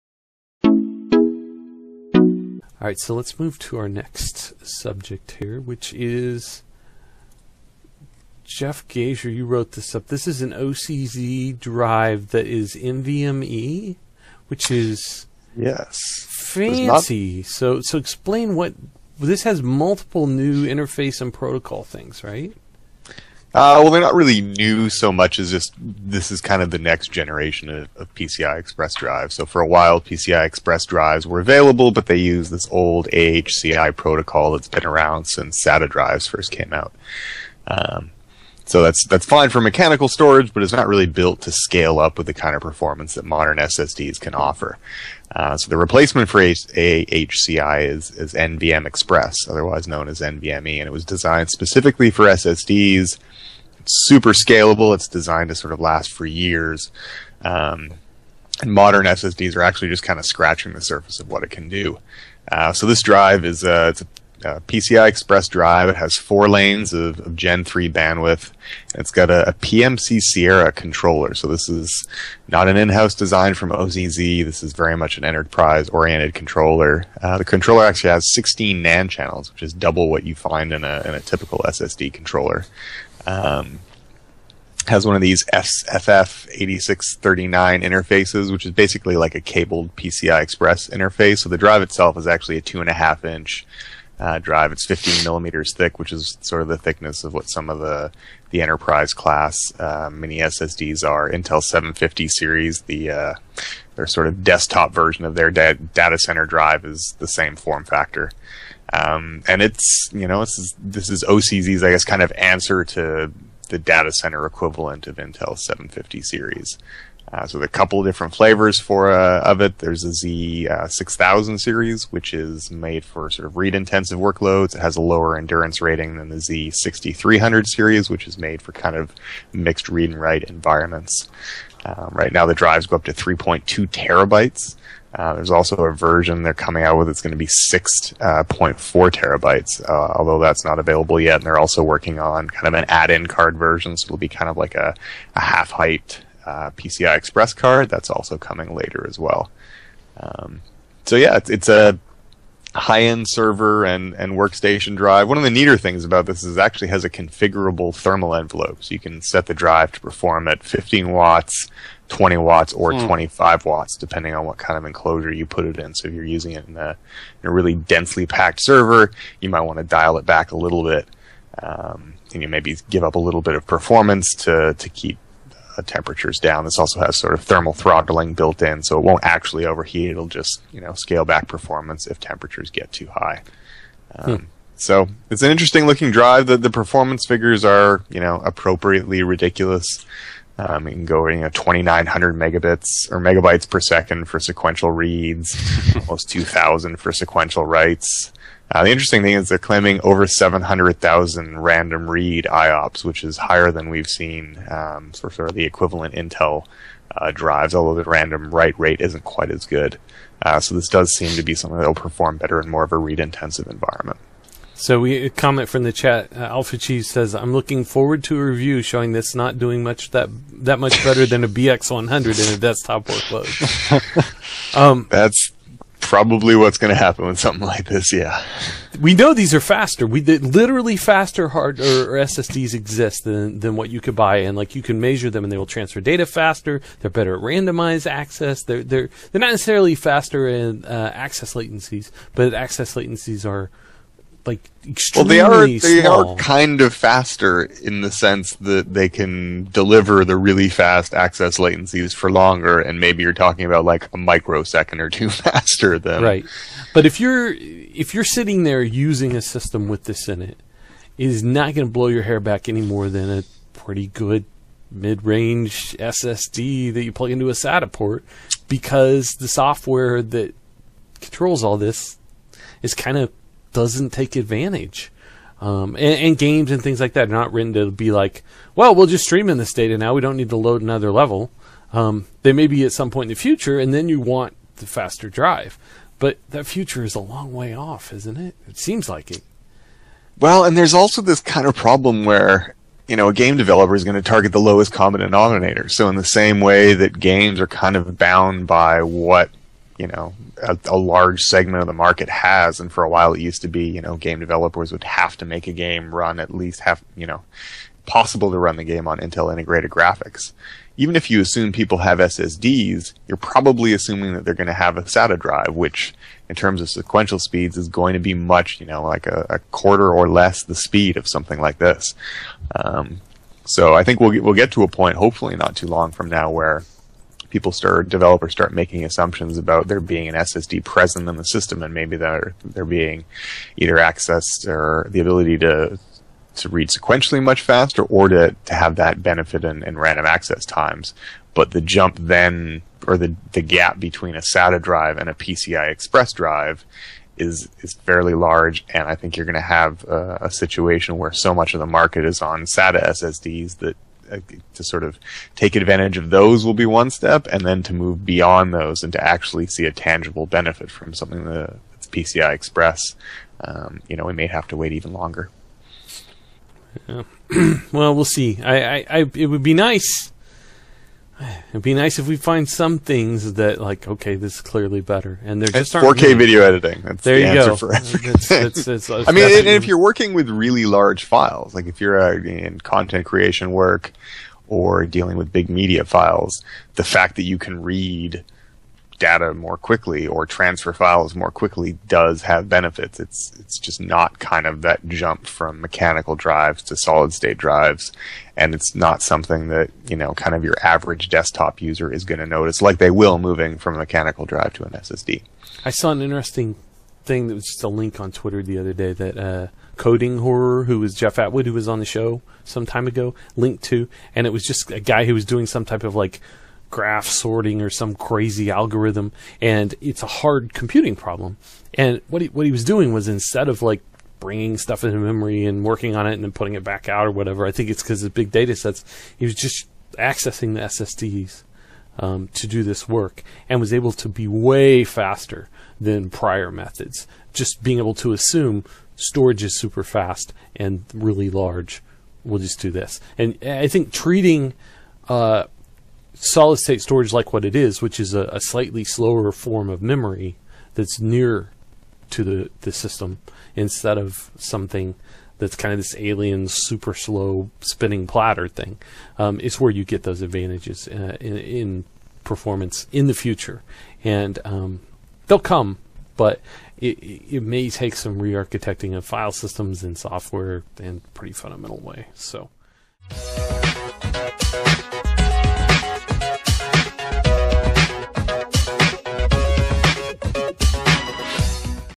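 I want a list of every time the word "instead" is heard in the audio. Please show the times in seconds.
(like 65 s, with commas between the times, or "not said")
423 s, 453 s.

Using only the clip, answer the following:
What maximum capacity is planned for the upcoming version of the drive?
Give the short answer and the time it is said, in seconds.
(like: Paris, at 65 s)
6.4 terabytes, at 137 s.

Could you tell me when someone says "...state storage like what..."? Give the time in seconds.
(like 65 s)
446 s.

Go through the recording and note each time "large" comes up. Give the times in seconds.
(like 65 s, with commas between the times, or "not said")
300 s, 348 s, 380 s, 441 s.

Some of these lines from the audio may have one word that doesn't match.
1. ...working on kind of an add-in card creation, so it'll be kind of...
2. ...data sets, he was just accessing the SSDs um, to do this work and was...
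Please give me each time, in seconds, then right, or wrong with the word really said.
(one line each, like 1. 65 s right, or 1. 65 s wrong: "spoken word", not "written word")
1. 141 s wrong: "version", not "creation"
2. 428 s right.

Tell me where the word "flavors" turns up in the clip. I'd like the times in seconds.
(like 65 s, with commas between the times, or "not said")
118 s.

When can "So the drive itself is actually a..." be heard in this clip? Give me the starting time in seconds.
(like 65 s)
91 s.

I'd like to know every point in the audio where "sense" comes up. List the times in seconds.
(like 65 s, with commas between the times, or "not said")
248 s.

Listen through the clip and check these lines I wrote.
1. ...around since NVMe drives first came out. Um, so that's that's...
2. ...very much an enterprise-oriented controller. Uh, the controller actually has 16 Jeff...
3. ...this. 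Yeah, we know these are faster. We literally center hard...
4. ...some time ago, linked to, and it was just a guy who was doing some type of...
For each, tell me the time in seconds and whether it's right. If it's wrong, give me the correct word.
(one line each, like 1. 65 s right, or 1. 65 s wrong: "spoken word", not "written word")
1. 34 s wrong: "SATA", not "NVMe"
2. 74 s wrong: "NAND", not "Jeff"
3. 227 s wrong: "faster", not "center"
4. 412 s right.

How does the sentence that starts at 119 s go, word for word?
There's a Z uh, 6000 series, which is made for sort of read-intensive workloads.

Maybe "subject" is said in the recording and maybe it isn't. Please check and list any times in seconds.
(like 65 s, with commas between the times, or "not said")
4 s.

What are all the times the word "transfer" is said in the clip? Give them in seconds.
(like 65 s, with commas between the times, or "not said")
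235 s, 390 s.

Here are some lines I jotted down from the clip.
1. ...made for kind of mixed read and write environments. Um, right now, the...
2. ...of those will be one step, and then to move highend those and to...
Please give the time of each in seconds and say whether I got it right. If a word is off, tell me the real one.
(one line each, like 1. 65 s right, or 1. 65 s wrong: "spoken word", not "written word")
1. 128 s right
2. 356 s wrong: "beyond", not "highend".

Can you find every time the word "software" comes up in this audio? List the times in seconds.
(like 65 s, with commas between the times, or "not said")
269 s, 470 s.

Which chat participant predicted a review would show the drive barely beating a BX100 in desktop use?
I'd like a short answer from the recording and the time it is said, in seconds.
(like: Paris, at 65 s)
Alpha Cheese, at 216 s.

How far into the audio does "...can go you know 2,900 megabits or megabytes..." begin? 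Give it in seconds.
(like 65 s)
190 s.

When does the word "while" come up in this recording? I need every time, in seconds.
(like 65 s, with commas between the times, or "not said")
29 s, 303 s.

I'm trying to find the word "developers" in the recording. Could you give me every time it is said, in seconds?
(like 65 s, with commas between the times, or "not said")
293 s, 304 s, 328 s.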